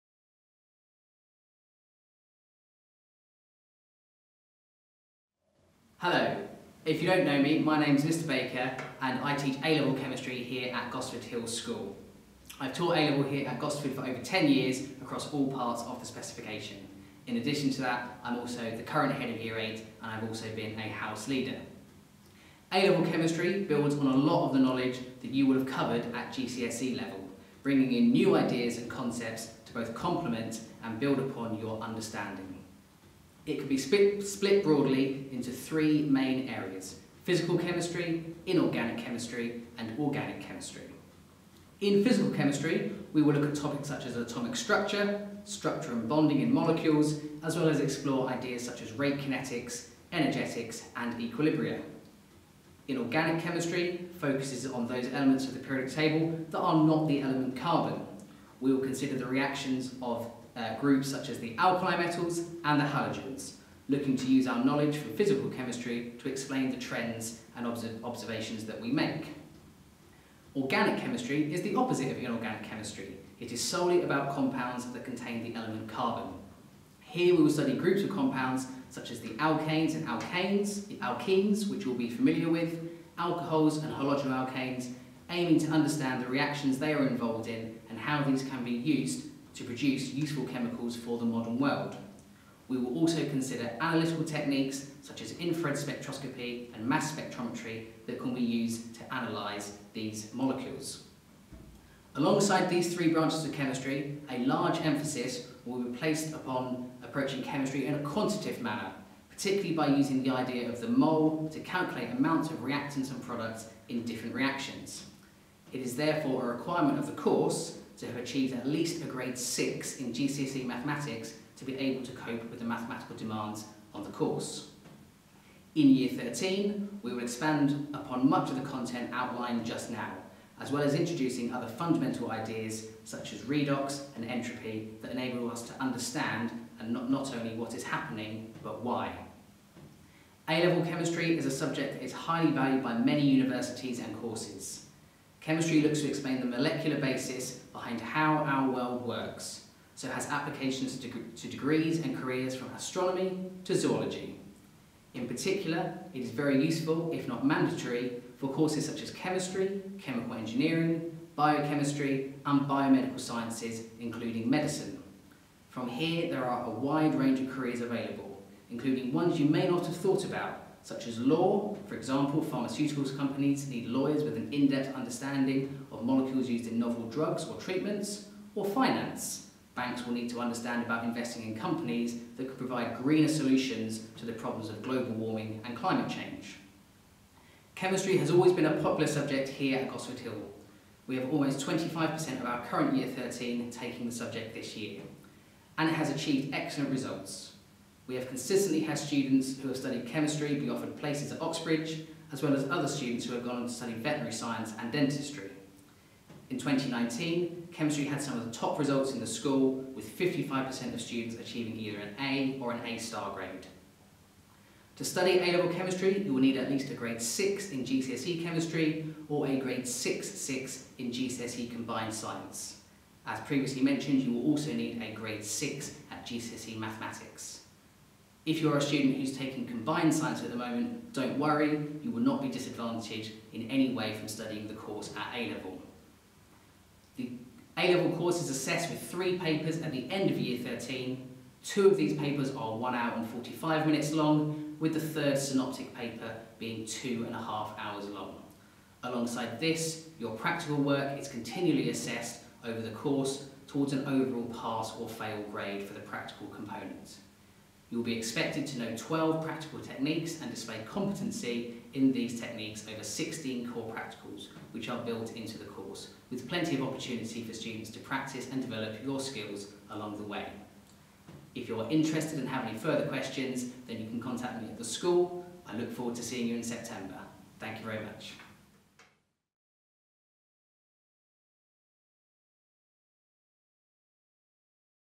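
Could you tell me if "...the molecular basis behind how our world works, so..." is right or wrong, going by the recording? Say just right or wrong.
right.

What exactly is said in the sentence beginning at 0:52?
Inorganic chemistry focuses on those elements of the periodic table that are not the element carbon.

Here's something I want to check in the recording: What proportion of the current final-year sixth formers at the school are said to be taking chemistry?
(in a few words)
25%.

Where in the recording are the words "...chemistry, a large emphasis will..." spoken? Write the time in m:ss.
1:43.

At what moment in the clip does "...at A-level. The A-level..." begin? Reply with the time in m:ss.
3:55.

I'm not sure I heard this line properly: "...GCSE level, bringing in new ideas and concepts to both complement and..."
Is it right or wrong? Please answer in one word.
right.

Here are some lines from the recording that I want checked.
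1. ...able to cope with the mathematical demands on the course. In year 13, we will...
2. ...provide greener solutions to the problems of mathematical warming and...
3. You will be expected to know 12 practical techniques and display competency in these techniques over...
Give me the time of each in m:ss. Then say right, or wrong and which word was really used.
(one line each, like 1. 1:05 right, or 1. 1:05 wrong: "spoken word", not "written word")
1. 2:01 right
2. 3:02 wrong: "global", not "mathematical"
3. 4:17 right.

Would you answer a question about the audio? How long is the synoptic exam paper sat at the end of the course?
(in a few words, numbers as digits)
2.5 hours.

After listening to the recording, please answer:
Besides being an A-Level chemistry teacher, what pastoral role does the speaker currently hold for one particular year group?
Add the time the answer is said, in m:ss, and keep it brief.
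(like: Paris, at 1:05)
Head of Year 8, at 0:19.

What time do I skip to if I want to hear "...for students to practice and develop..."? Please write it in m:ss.
4:27.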